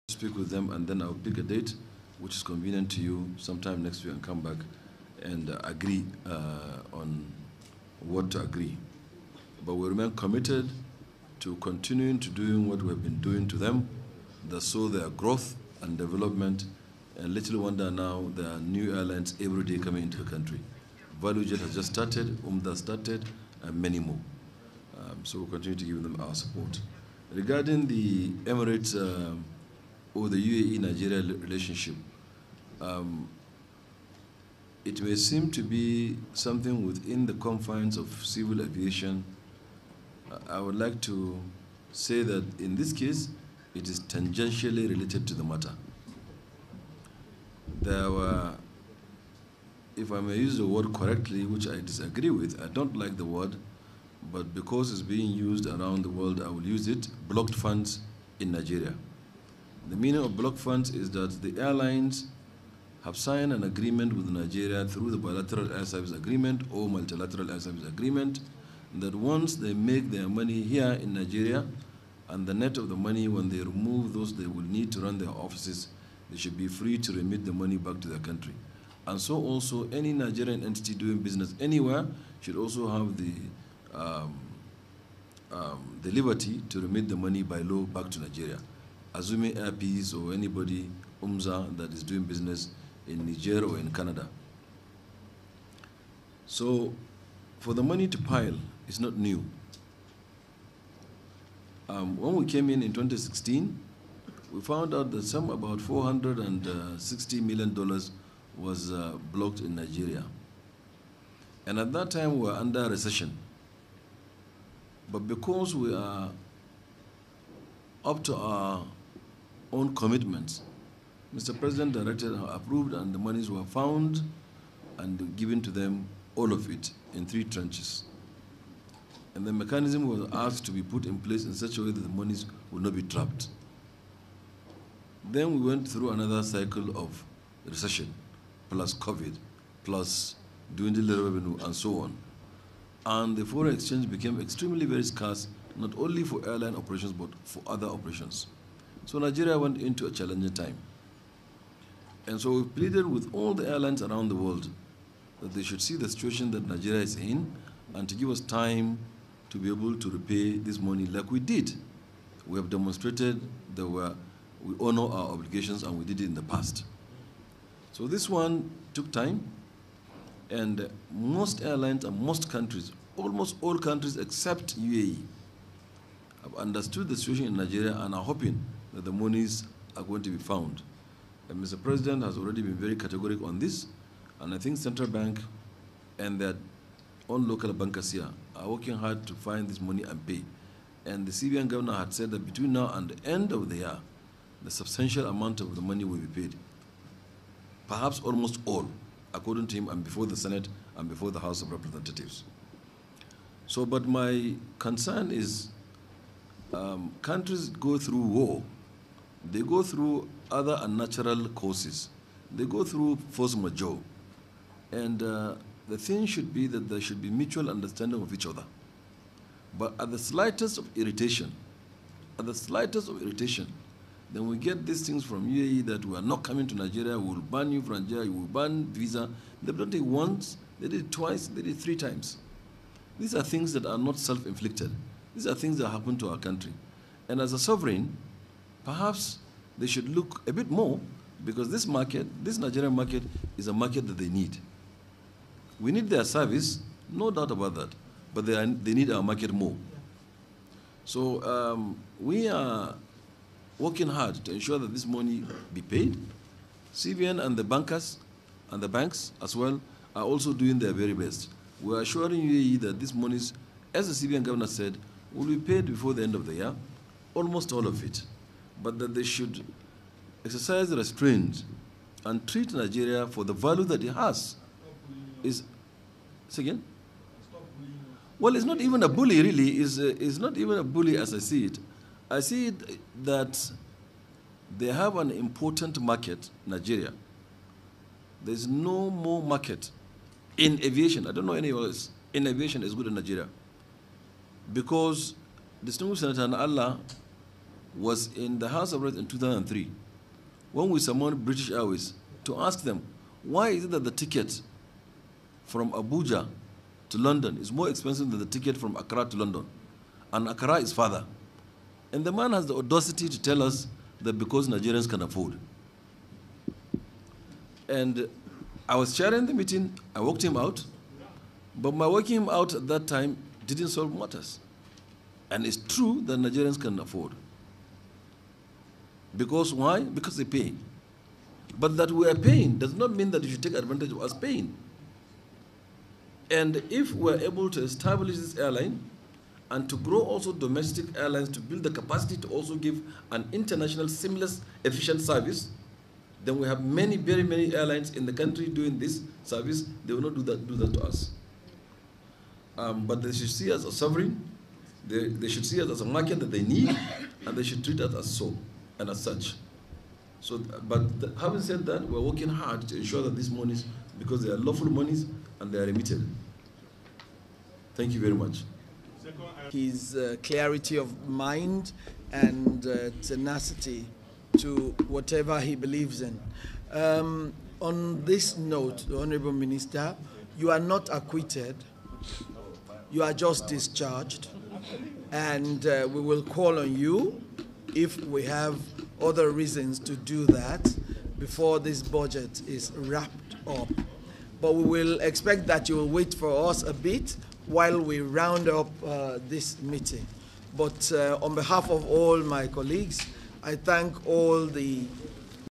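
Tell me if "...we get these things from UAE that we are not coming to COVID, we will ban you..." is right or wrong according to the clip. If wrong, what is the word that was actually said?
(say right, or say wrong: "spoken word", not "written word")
wrong: "Nigeria", not "COVID".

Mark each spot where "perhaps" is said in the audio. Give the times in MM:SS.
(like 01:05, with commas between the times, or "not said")
03:17, 03:58.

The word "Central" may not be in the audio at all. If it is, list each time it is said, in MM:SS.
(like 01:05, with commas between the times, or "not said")
03:04.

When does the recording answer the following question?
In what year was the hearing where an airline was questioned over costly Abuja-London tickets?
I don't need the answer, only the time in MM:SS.
04:59.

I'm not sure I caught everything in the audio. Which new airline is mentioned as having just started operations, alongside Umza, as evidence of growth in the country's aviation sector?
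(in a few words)
ValueJet.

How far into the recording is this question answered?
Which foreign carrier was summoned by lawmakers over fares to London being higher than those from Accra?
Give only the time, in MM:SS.
05:01.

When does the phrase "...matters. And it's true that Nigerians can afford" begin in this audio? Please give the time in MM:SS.
05:24.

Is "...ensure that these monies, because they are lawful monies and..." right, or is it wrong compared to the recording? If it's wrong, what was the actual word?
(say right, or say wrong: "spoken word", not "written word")
right.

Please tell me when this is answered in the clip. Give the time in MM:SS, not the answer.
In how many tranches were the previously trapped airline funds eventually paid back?
02:07.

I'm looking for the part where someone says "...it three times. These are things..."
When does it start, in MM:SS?
03:51.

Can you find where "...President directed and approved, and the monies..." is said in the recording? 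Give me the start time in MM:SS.
02:01.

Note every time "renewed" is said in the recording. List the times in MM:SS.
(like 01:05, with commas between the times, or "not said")
not said.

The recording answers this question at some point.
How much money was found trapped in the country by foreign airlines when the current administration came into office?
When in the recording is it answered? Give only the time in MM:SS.
01:45.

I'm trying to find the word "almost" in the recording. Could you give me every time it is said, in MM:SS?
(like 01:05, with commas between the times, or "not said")
02:53, 03:18, 04:27.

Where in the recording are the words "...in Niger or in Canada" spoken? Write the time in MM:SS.
01:33.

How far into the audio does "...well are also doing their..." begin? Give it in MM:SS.
04:19.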